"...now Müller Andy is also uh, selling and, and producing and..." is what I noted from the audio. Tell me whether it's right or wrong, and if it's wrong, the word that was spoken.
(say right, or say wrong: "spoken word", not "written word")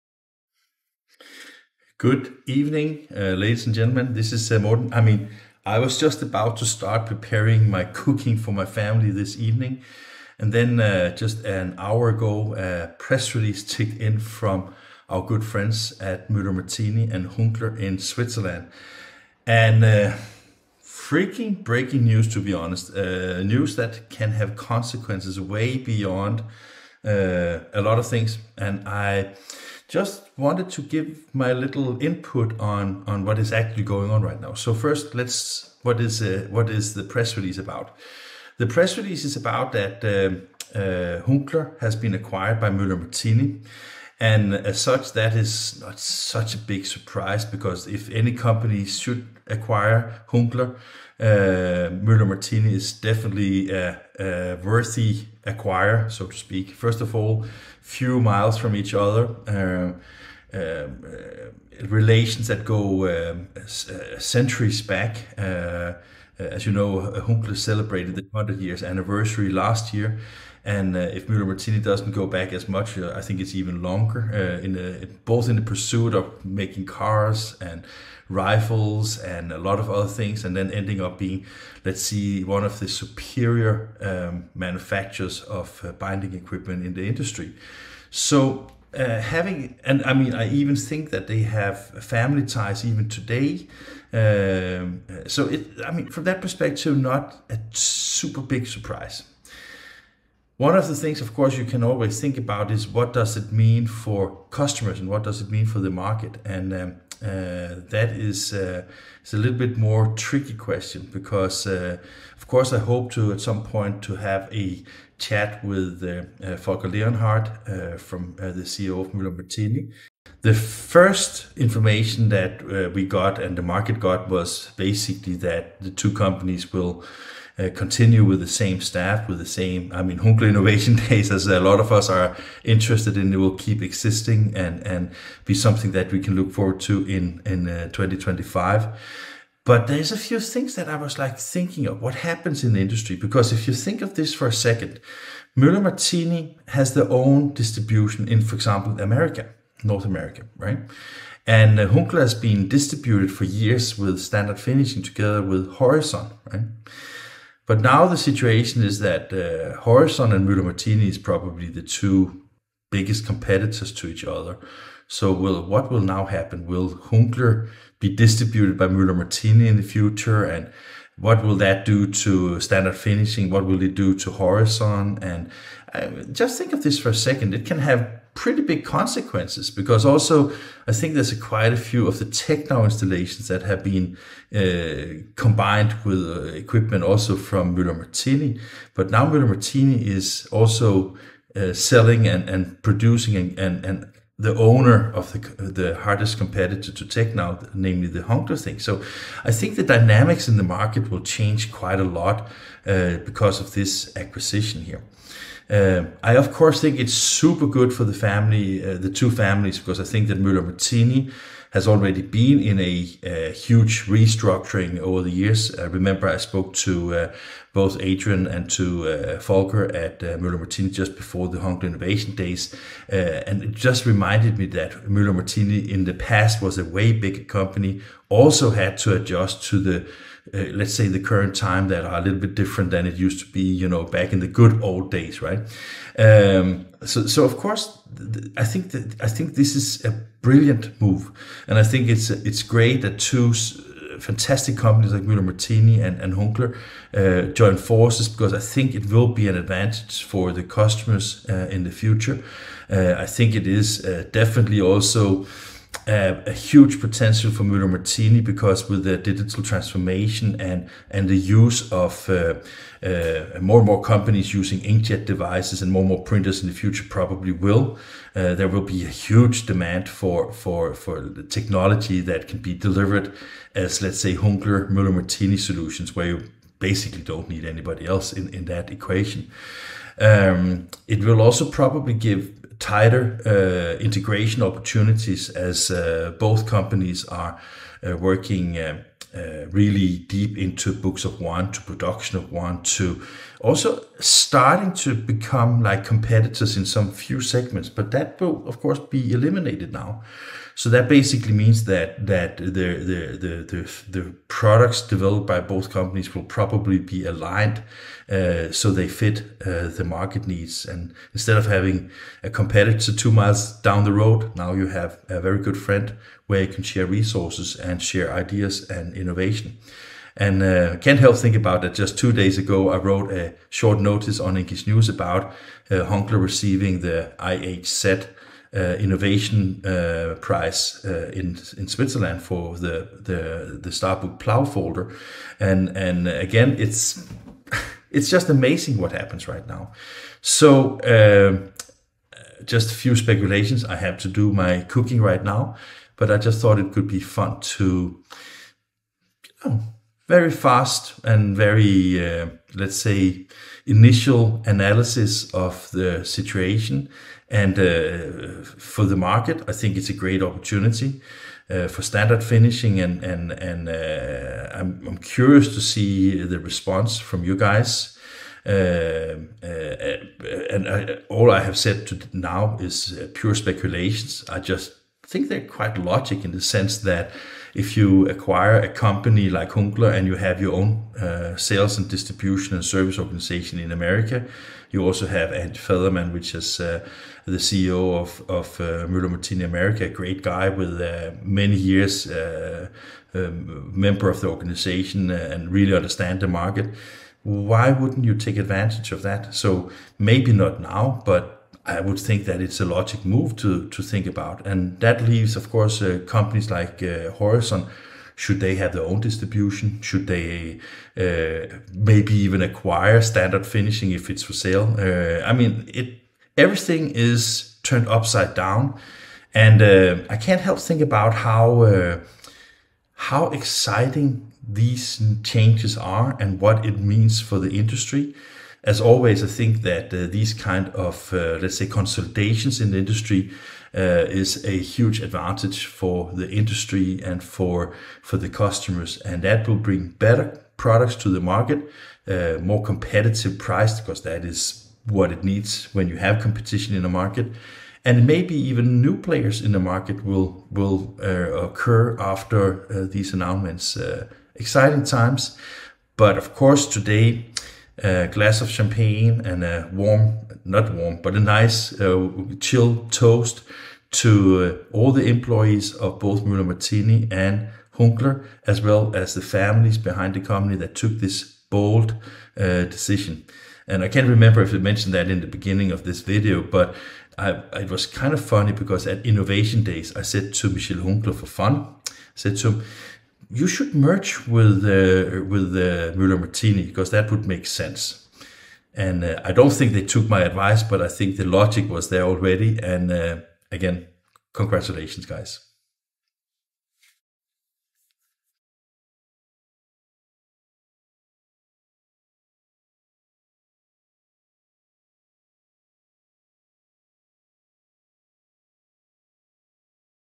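wrong: "Martini", not "Andy".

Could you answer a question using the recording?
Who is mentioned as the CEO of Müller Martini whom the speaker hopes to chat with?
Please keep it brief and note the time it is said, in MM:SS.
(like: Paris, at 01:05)
Volker Leonhardt, at 01:56.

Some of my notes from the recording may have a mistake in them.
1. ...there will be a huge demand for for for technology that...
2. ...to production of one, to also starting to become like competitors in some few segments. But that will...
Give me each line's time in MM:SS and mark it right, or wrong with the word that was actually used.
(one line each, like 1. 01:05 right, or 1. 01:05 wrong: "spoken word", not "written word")
1. 04:28 right
2. 04:51 right.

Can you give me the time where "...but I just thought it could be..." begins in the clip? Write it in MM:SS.
05:46.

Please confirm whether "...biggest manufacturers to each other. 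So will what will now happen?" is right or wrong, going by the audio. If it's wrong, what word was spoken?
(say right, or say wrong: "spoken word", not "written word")
wrong: "competitors", not "manufacturers".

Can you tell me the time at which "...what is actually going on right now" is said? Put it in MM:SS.
00:33.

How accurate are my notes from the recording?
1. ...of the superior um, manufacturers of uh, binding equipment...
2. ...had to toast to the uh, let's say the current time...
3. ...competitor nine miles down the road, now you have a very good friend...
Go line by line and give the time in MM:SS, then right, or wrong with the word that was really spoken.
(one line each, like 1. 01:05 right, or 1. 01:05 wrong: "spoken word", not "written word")
1. 01:22 right
2. 03:48 wrong: "adjust", not "toast"
3. 05:12 wrong: "two", not "nine".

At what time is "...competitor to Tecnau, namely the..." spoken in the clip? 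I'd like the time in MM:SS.
03:16.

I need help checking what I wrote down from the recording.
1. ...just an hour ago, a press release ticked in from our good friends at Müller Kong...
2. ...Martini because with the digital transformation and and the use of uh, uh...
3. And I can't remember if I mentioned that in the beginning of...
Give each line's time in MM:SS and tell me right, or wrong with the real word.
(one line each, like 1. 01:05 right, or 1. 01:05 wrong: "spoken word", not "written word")
1. 00:11 wrong: "Martini", not "Kong"
2. 04:17 right
3. 07:53 right.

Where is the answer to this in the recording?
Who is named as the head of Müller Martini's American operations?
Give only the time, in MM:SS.
06:25.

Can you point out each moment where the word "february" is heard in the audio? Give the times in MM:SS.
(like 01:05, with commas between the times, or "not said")
not said.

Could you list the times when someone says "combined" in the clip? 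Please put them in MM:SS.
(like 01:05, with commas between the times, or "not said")
03:05.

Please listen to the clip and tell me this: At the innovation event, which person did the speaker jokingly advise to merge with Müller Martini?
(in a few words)
Michel Hunkeler.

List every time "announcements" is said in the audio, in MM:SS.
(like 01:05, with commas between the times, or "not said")
07:33.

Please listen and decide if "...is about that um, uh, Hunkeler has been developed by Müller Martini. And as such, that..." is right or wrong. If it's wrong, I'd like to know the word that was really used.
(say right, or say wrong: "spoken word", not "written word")
wrong: "acquired", not "developed".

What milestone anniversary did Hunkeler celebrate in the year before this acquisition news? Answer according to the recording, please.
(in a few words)
100 years.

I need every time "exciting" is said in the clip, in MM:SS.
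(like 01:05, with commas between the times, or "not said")
07:03, 07:34.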